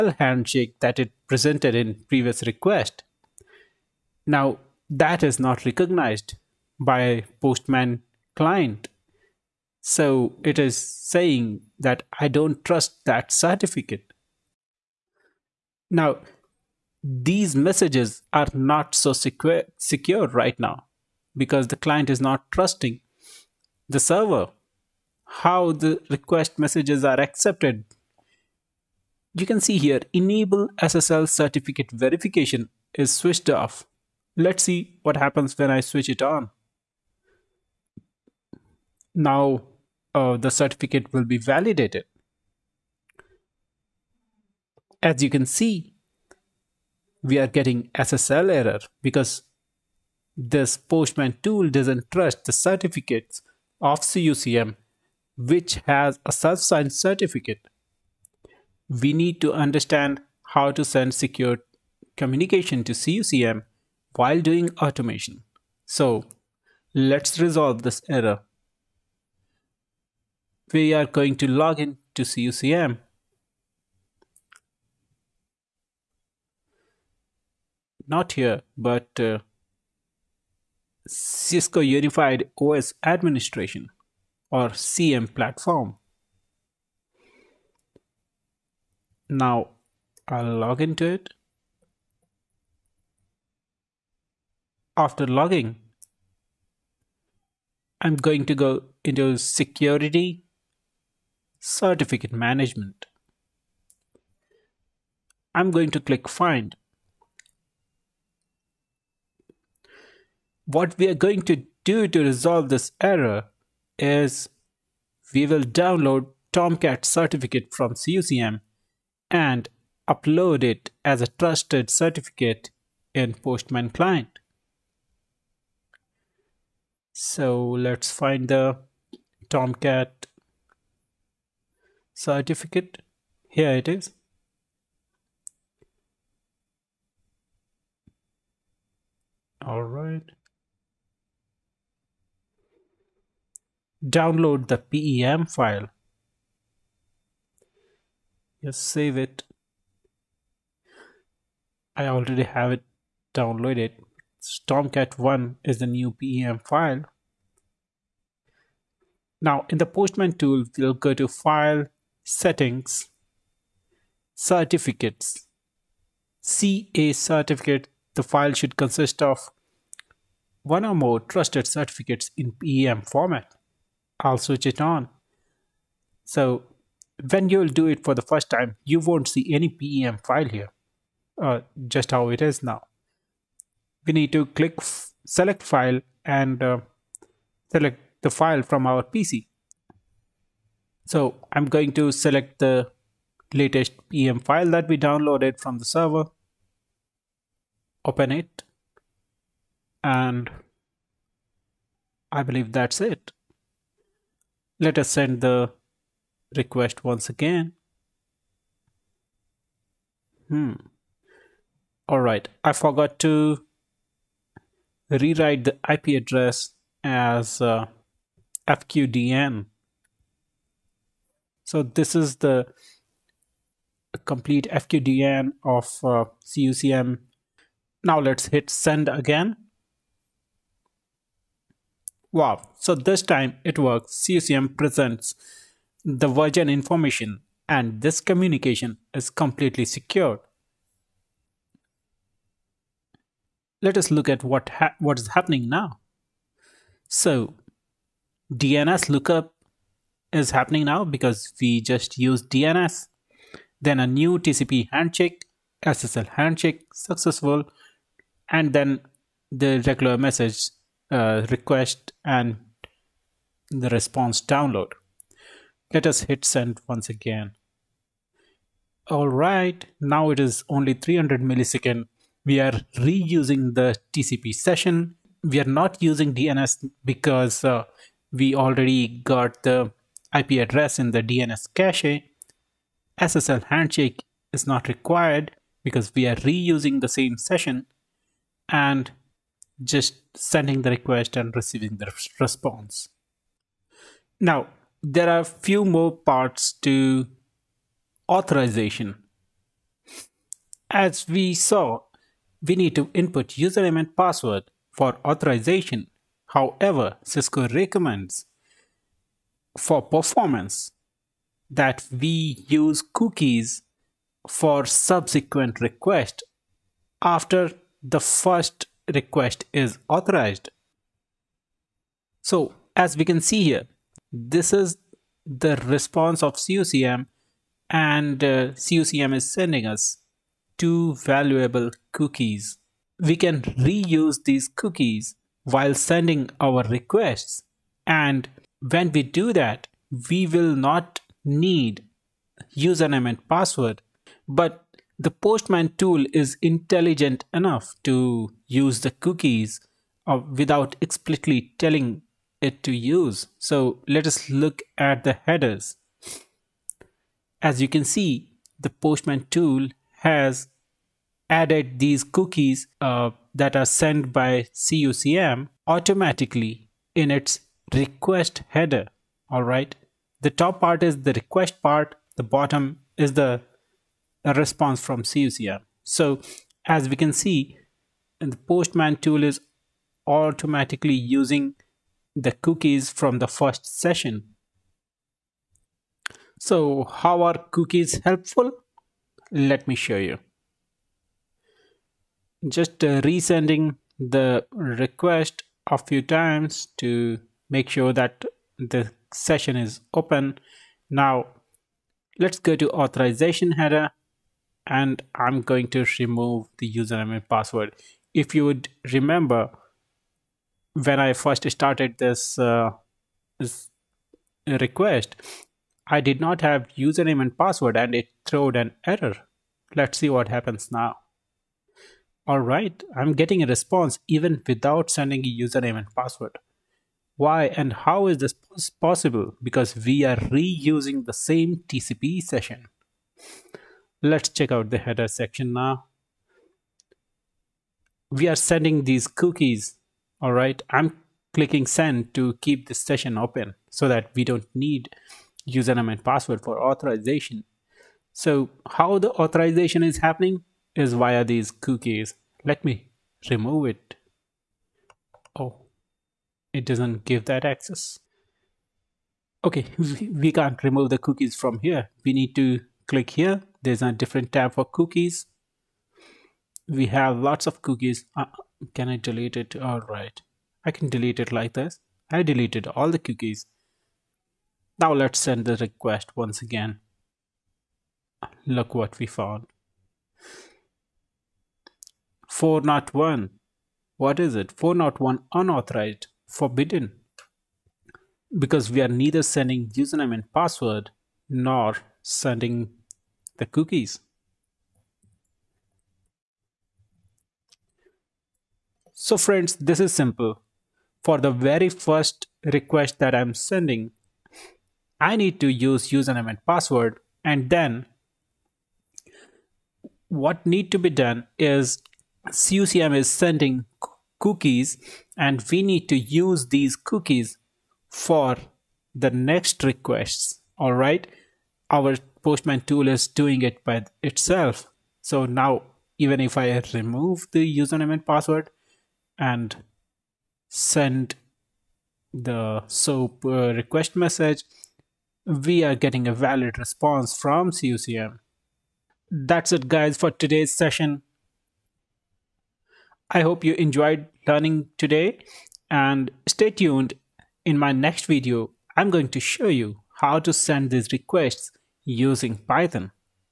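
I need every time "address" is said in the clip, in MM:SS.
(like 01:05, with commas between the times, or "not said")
03:36, 04:40.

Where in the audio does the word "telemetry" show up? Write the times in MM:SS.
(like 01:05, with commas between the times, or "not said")
not said.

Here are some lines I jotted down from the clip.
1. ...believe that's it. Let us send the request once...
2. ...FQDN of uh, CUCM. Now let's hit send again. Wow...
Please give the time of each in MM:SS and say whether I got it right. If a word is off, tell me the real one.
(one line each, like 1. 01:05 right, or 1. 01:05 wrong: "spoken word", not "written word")
1. 03:22 right
2. 03:44 right.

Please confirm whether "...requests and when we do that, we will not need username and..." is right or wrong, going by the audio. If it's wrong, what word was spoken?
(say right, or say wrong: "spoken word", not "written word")
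right.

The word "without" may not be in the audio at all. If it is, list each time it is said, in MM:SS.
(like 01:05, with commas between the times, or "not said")
05:50, 07:04.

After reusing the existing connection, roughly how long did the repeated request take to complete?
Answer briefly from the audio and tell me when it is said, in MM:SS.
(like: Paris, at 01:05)
300 milliseconds, at 04:30.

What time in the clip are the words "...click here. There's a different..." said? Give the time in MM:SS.
07:43.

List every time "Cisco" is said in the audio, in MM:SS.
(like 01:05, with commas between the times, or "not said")
01:21, 05:07.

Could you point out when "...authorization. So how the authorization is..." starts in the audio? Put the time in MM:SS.
07:26.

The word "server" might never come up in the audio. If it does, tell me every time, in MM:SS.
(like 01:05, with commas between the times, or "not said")
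00:23, 03:15.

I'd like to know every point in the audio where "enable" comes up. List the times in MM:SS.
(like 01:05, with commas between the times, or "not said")
00:30.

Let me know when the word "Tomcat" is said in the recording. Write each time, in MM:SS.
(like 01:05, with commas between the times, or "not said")
01:56, 02:09.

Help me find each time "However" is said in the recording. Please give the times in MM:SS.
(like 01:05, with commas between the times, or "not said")
05:06.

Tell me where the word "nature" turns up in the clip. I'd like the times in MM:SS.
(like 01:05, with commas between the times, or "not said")
not said.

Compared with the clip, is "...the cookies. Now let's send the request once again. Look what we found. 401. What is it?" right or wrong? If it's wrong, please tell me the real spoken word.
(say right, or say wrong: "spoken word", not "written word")
right.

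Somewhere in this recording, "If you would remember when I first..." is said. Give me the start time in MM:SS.
06:48.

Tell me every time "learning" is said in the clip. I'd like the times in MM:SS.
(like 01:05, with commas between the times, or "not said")
09:04.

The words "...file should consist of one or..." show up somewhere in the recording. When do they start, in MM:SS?
02:48.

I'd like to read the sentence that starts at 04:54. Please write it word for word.
Now, there are a few more parts to authorization.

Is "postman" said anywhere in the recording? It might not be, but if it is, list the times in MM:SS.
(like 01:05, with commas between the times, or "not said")
00:07, 00:50, 02:03, 02:39, 05:45, 05:58, 06:18, 08:42.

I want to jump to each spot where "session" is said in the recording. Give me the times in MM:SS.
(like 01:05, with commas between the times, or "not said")
04:34, 04:47, 06:23, 06:39, 07:12, 07:22, 09:00.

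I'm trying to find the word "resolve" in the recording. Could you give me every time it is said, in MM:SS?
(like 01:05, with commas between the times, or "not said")
01:07, 01:52.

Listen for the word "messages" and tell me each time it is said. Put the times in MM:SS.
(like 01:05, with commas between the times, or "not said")
00:17, 00:26, 04:20, 08:54.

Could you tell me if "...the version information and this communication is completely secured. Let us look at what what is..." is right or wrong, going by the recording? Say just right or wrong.
right.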